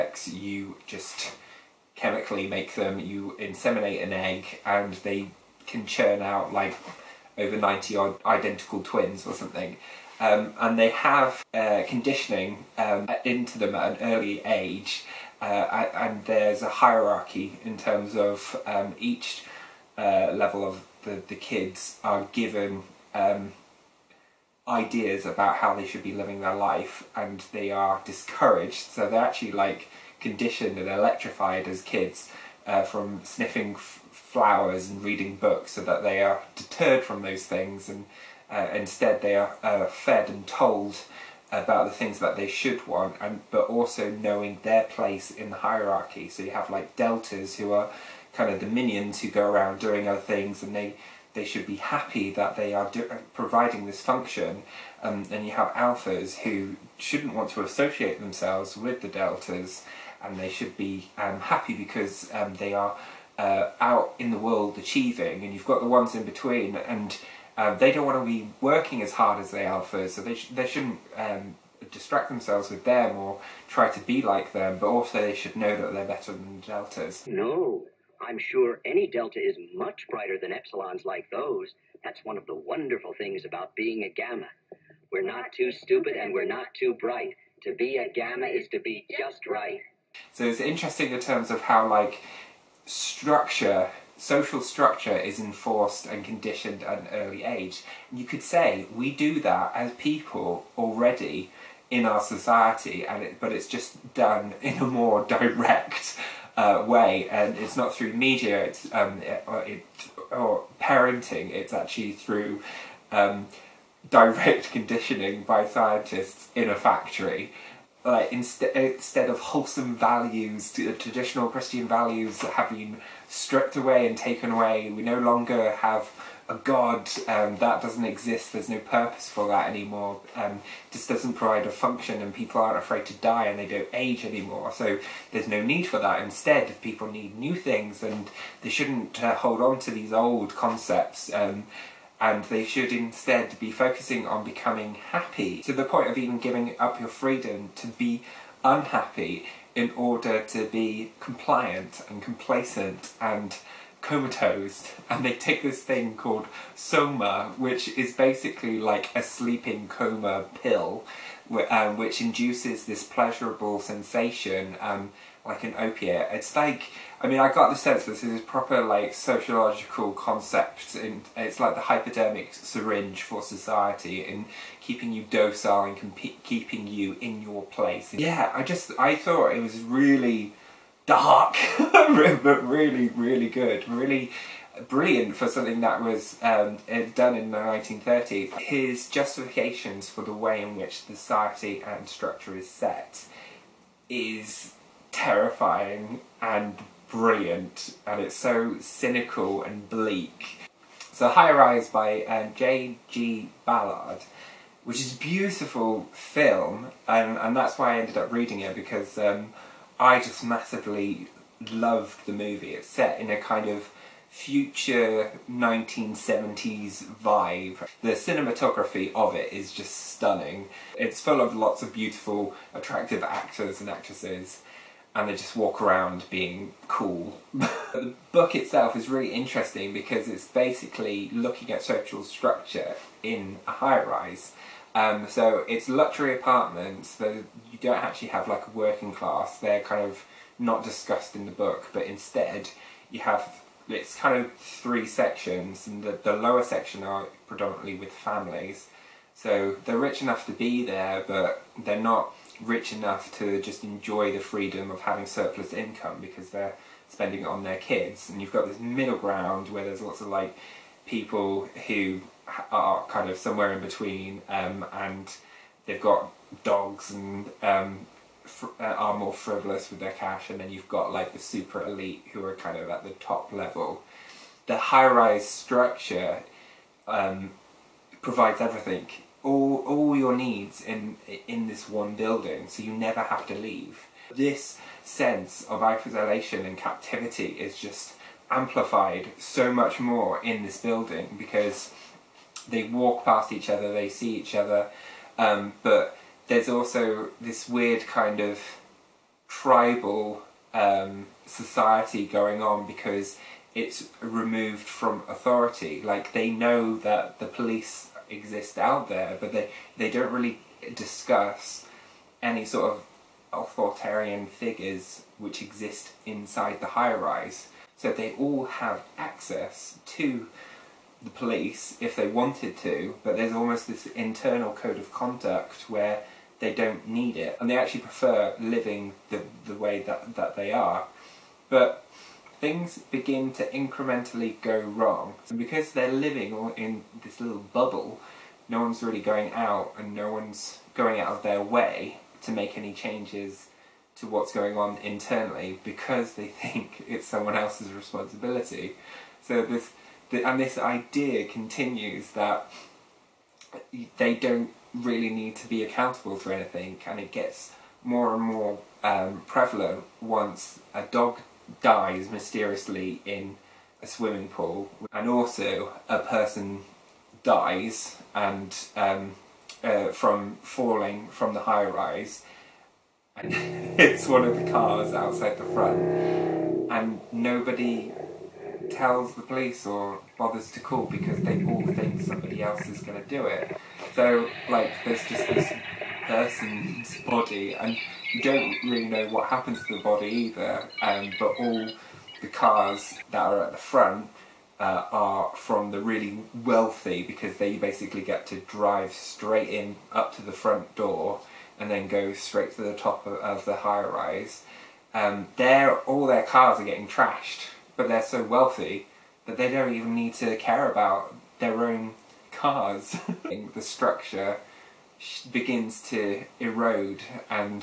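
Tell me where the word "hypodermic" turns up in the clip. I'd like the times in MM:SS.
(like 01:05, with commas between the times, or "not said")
02:51.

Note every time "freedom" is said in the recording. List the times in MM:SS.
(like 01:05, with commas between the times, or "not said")
02:27, 04:14.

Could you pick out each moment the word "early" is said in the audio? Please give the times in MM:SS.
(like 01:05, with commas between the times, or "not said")
00:14, 01:37.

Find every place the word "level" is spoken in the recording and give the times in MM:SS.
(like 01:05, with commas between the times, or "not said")
00:20, 04:33.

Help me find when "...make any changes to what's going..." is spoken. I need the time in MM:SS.
05:42.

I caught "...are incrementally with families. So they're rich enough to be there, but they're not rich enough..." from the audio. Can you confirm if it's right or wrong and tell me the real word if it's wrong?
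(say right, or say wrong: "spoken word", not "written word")
wrong: "predominantly", not "incrementally".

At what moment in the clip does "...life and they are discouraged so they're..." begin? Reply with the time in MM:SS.
00:26.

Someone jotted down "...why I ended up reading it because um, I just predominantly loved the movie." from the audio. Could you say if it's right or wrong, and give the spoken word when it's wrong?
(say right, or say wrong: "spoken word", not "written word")
wrong: "massively", not "predominantly".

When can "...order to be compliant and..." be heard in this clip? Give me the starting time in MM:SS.
02:29.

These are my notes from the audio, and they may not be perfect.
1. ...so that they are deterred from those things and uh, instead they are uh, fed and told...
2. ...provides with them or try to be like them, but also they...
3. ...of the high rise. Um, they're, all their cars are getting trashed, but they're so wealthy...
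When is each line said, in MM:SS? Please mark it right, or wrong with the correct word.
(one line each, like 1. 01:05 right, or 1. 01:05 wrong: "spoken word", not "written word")
1. 00:35 right
2. 01:12 wrong: "themselves", not "provides"
3. 06:43 right.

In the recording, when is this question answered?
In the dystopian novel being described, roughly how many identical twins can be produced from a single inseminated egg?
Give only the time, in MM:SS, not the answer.
00:07.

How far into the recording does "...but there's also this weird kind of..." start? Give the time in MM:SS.
04:55.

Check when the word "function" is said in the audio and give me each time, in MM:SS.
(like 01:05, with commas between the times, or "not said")
00:54, 02:11.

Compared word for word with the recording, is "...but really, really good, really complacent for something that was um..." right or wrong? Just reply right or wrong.
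wrong.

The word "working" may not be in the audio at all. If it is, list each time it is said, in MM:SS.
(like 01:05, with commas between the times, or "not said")
01:08, 03:58.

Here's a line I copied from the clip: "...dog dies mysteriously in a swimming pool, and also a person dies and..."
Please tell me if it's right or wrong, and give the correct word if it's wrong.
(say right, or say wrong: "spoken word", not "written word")
right.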